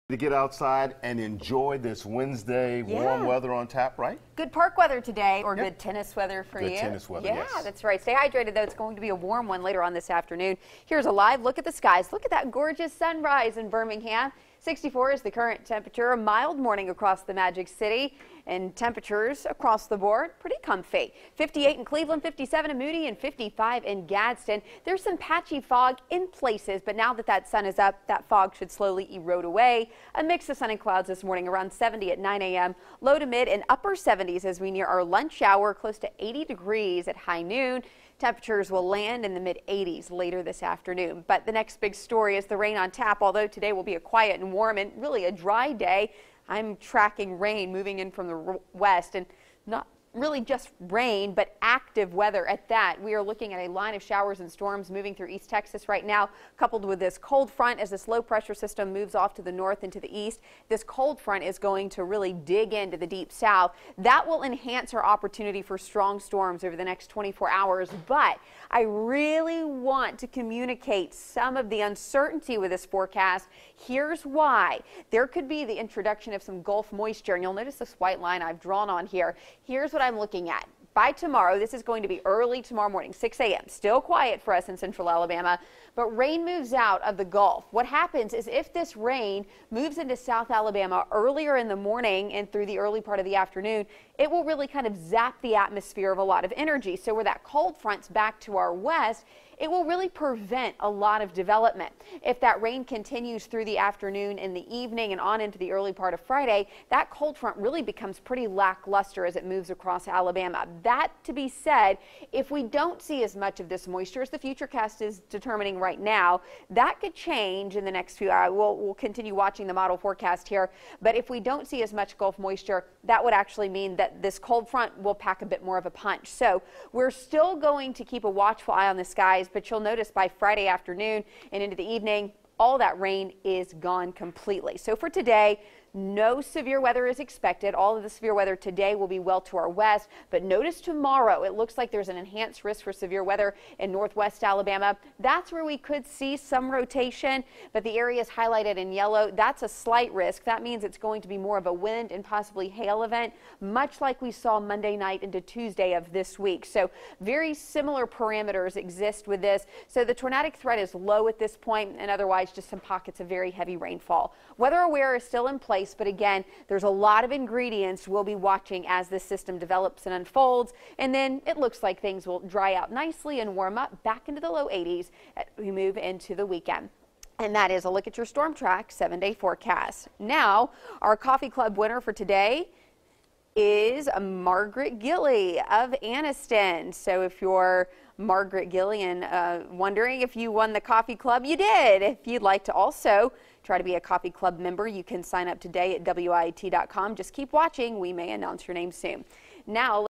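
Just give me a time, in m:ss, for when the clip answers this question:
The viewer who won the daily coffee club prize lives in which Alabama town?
3:06.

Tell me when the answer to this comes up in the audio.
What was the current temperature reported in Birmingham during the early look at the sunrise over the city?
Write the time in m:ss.
0:14.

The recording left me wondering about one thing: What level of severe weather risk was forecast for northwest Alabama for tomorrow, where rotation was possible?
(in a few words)
enhanced risk.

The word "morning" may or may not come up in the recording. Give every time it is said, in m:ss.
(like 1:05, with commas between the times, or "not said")
0:16, 0:31, 1:22, 1:31.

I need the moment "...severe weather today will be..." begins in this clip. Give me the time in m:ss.
2:18.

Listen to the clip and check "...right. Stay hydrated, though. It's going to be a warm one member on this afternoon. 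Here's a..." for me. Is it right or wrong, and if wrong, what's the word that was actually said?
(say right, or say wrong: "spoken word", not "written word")
wrong: "later", not "member".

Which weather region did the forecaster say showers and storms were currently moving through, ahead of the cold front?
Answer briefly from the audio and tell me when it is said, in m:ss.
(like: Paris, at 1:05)
East Texas, at 0:55.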